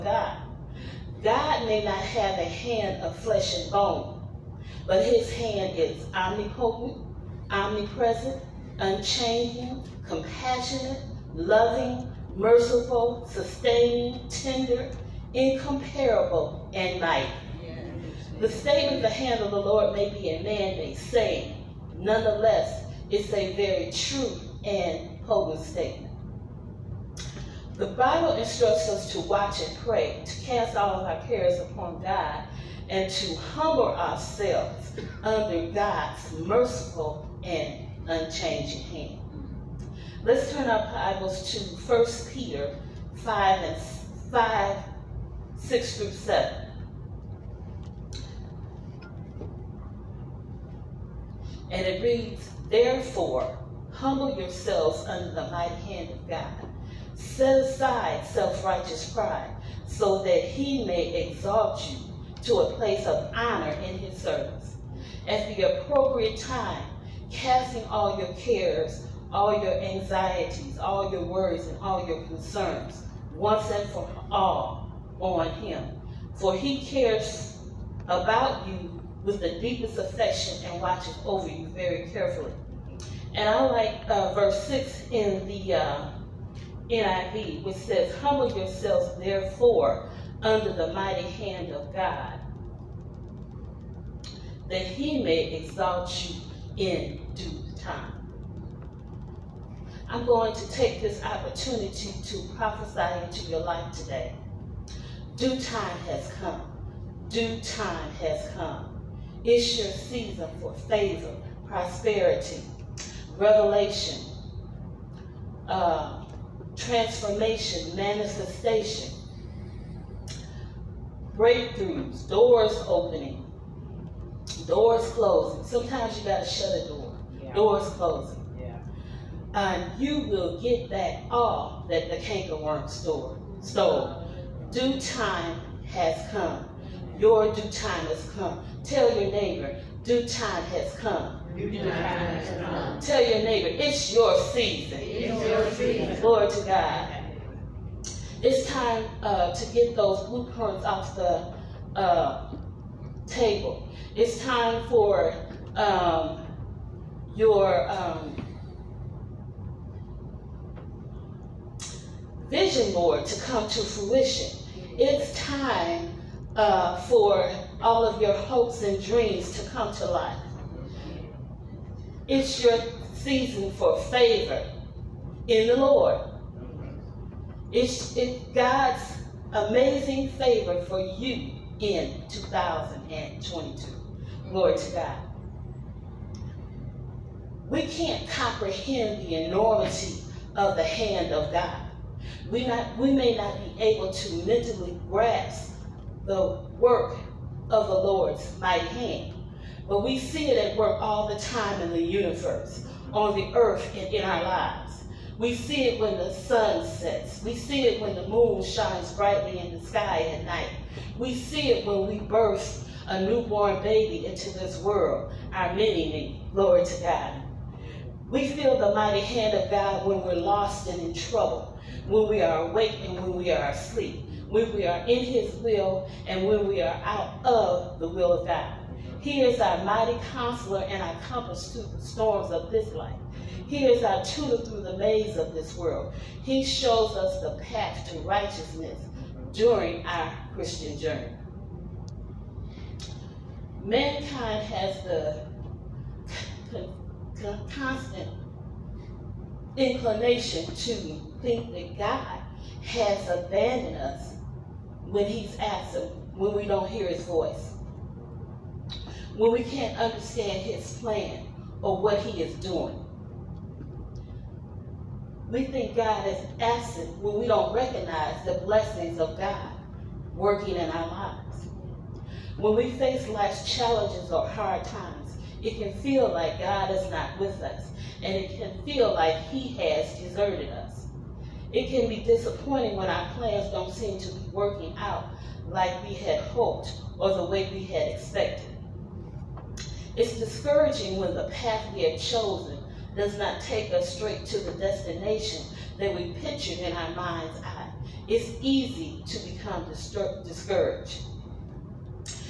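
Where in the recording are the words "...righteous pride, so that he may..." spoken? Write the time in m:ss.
0:58.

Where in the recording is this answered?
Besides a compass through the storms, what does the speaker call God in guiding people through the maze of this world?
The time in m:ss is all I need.
3:54.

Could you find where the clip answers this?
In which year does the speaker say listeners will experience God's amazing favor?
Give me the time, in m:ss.
3:02.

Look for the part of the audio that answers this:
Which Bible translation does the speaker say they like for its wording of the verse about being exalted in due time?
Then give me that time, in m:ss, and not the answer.
1:26.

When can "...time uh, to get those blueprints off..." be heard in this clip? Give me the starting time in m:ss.
2:28.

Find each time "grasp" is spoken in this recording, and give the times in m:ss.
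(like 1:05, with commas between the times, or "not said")
3:15.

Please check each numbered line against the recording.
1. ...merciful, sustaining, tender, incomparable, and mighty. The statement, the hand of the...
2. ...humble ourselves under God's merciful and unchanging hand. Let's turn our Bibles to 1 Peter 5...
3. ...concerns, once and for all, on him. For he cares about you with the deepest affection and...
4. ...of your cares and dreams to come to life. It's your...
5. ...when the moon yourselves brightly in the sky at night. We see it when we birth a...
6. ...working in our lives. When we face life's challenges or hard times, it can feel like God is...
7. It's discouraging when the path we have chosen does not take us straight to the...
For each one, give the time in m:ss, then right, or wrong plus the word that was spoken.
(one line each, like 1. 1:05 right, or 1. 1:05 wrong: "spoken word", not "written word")
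1. 0:12 right
2. 0:33 right
3. 1:12 right
4. 2:48 wrong: "hopes", not "cares"
5. 3:28 wrong: "shines", not "yourselves"
6. 4:30 right
7. 4:50 right.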